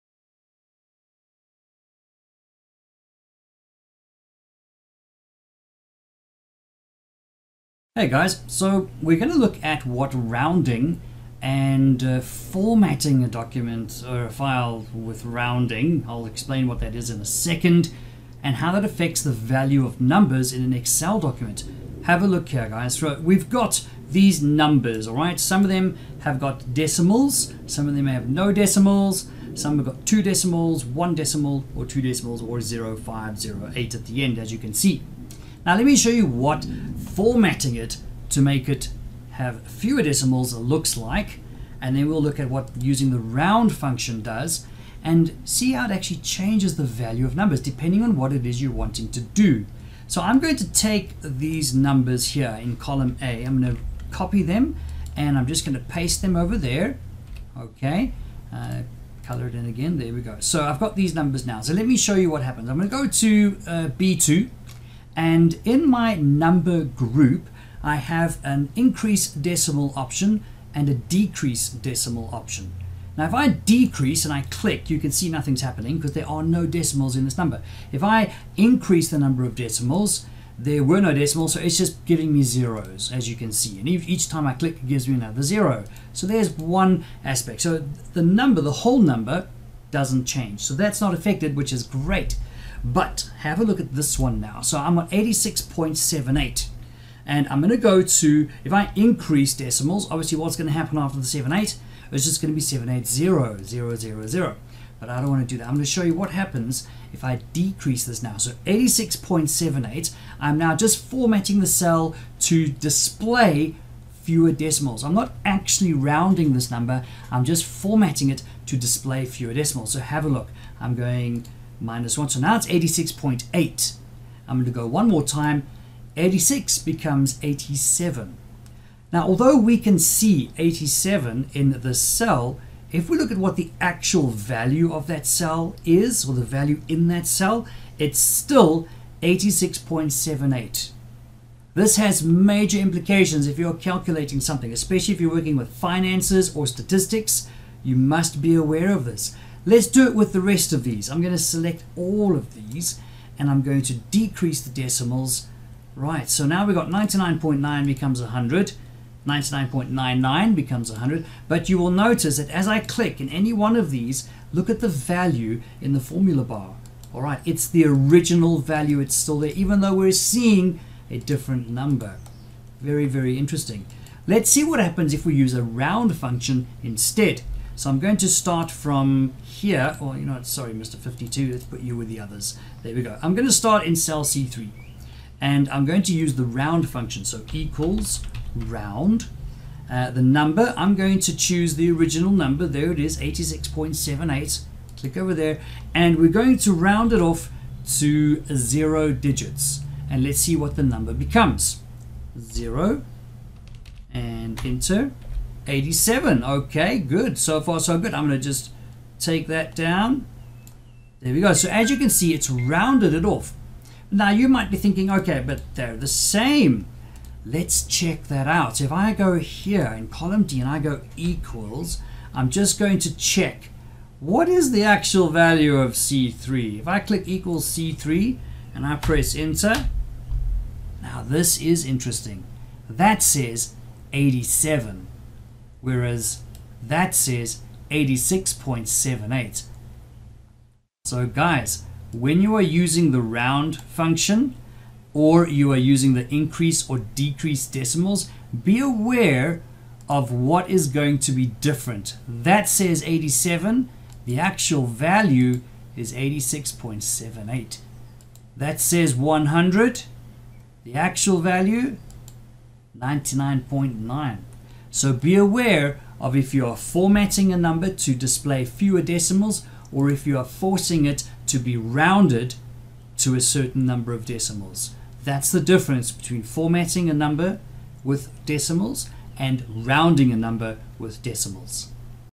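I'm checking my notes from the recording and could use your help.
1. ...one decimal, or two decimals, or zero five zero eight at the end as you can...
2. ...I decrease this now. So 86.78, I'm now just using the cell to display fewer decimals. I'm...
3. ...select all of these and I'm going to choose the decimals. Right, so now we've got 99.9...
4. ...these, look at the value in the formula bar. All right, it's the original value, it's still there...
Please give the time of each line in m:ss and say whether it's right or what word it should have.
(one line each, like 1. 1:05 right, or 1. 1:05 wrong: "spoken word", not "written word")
1. 0:30 right
2. 1:47 wrong: "formatting", not "using"
3. 2:31 wrong: "decrease", not "choose"
4. 2:43 right.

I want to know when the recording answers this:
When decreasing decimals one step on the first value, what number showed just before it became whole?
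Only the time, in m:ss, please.
2:02.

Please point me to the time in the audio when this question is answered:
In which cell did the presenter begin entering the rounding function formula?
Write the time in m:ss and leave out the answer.
3:03.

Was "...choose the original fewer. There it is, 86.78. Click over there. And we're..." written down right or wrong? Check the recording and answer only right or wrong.
wrong.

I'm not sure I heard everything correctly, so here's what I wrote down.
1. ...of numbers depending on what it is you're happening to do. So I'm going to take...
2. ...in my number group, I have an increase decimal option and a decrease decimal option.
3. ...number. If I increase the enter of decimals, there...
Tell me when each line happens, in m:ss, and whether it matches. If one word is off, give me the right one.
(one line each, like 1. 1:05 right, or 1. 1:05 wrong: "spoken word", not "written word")
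1. 0:47 wrong: "wanting", not "happening"
2. 1:05 right
3. 1:17 wrong: "number", not "enter".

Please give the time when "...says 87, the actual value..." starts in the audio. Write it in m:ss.
4:12.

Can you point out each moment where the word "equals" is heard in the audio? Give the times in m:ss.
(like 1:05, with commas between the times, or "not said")
3:07, 3:41, 3:47.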